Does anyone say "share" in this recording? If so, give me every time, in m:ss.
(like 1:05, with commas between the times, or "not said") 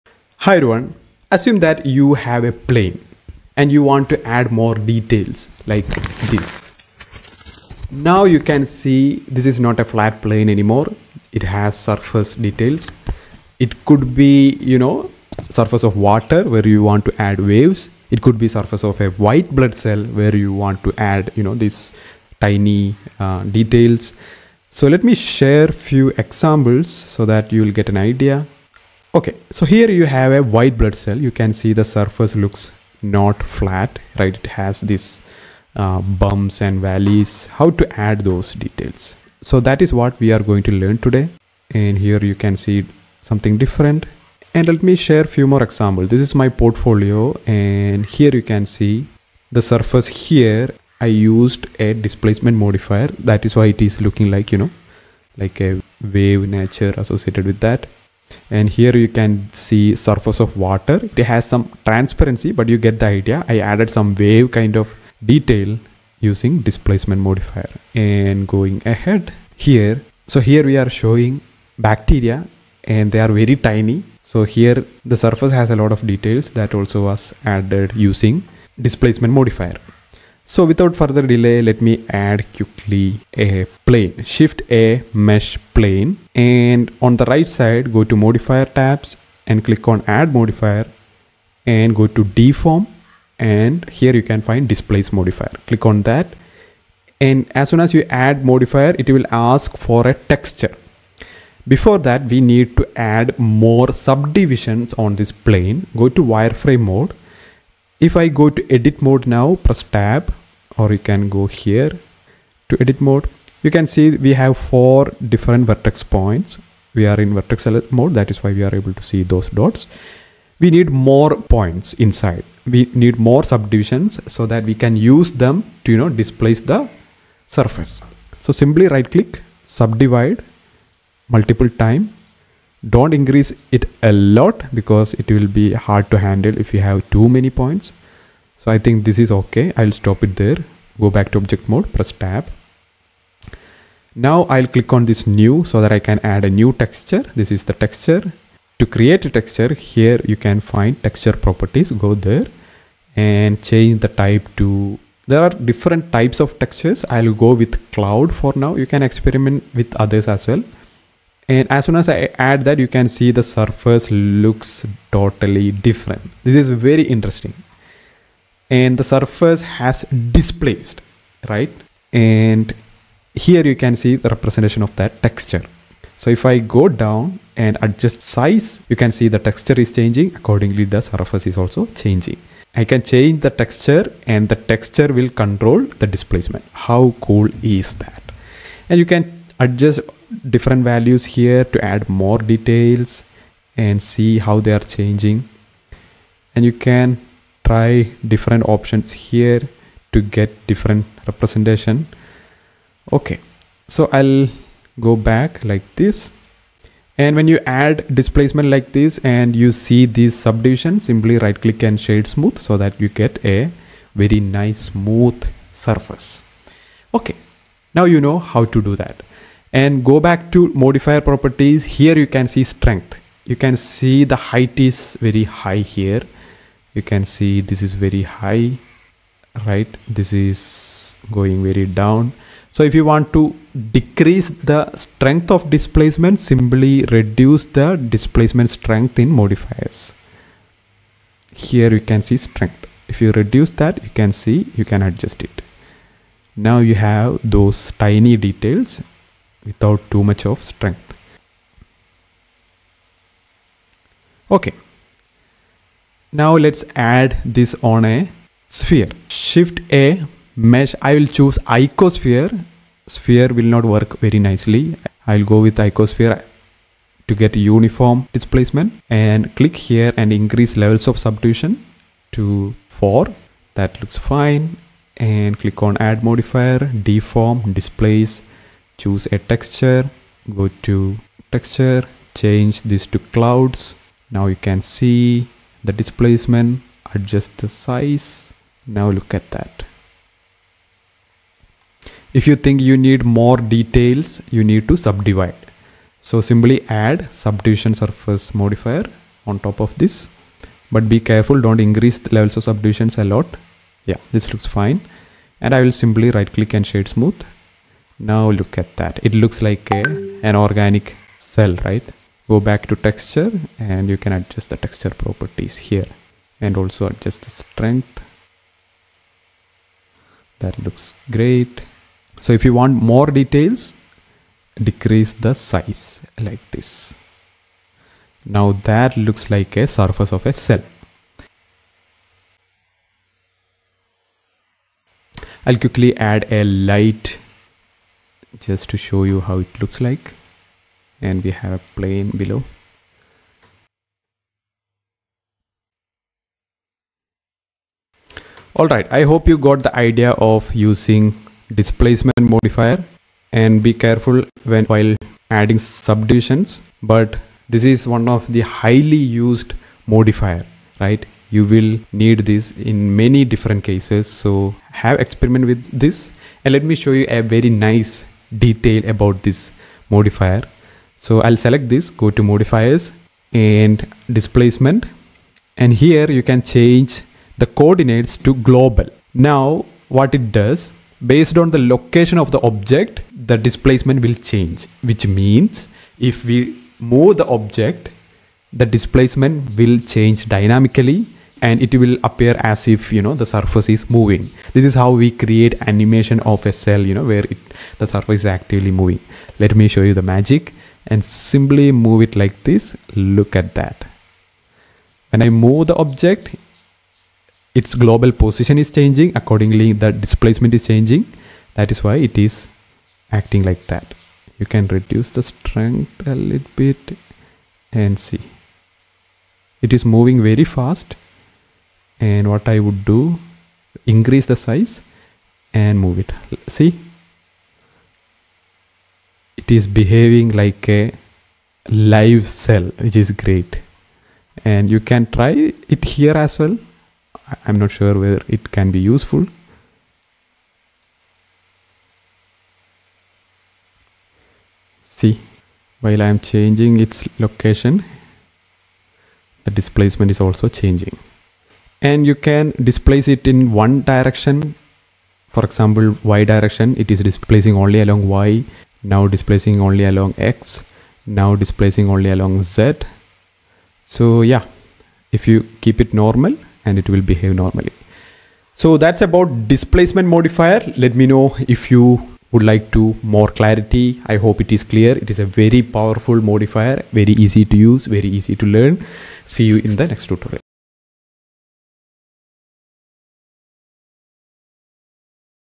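0:25, 0:44.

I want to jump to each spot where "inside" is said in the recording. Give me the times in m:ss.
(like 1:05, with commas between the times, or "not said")
2:02.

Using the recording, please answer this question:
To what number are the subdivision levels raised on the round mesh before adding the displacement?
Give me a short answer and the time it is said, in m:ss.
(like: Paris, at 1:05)
4, at 4:32.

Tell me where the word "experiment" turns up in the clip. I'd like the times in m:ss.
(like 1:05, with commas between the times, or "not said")
2:39, 6:05.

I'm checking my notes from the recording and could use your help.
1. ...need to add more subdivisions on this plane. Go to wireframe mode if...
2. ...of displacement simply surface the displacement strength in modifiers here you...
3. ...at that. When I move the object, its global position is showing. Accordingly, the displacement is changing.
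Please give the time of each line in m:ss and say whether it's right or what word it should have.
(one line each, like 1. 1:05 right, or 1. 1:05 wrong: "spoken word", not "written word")
1. 1:42 right
2. 3:55 wrong: "reduce", not "surface"
3. 6:43 wrong: "changing", not "showing".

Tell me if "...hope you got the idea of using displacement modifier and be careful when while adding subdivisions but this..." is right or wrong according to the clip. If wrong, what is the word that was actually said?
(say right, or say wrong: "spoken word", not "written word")
right.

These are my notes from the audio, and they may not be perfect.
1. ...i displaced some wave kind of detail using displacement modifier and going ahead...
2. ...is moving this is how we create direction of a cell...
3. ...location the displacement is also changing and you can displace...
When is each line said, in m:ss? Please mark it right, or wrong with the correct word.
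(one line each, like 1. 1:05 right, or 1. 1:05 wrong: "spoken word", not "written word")
1. 1:03 wrong: "added", not "displaced"
2. 6:33 wrong: "animation", not "direction"
3. 7:27 right.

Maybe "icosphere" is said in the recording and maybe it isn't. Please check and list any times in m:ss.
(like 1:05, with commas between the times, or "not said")
4:21, 4:25.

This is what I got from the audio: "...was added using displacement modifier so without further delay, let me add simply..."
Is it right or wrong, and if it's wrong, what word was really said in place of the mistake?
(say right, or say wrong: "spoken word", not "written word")
wrong: "quickly", not "simply".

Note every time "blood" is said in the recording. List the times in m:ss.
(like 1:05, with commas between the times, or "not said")
0:19, 0:30.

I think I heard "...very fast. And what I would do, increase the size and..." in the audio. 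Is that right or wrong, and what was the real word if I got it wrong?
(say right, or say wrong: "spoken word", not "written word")
right.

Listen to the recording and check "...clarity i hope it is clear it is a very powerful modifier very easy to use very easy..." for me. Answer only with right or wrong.
right.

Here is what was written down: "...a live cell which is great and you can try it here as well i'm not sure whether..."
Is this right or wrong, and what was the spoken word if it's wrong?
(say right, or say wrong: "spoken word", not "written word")
right.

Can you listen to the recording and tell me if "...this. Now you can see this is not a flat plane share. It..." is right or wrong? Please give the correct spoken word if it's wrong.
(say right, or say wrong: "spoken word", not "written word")
wrong: "anymore", not "share".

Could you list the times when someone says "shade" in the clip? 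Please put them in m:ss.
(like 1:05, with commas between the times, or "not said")
3:32, 5:06.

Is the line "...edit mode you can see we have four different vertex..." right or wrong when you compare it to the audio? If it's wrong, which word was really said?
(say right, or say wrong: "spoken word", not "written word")
right.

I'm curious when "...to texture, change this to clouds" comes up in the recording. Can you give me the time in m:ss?
4:40.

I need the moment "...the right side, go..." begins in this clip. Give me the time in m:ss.
1:27.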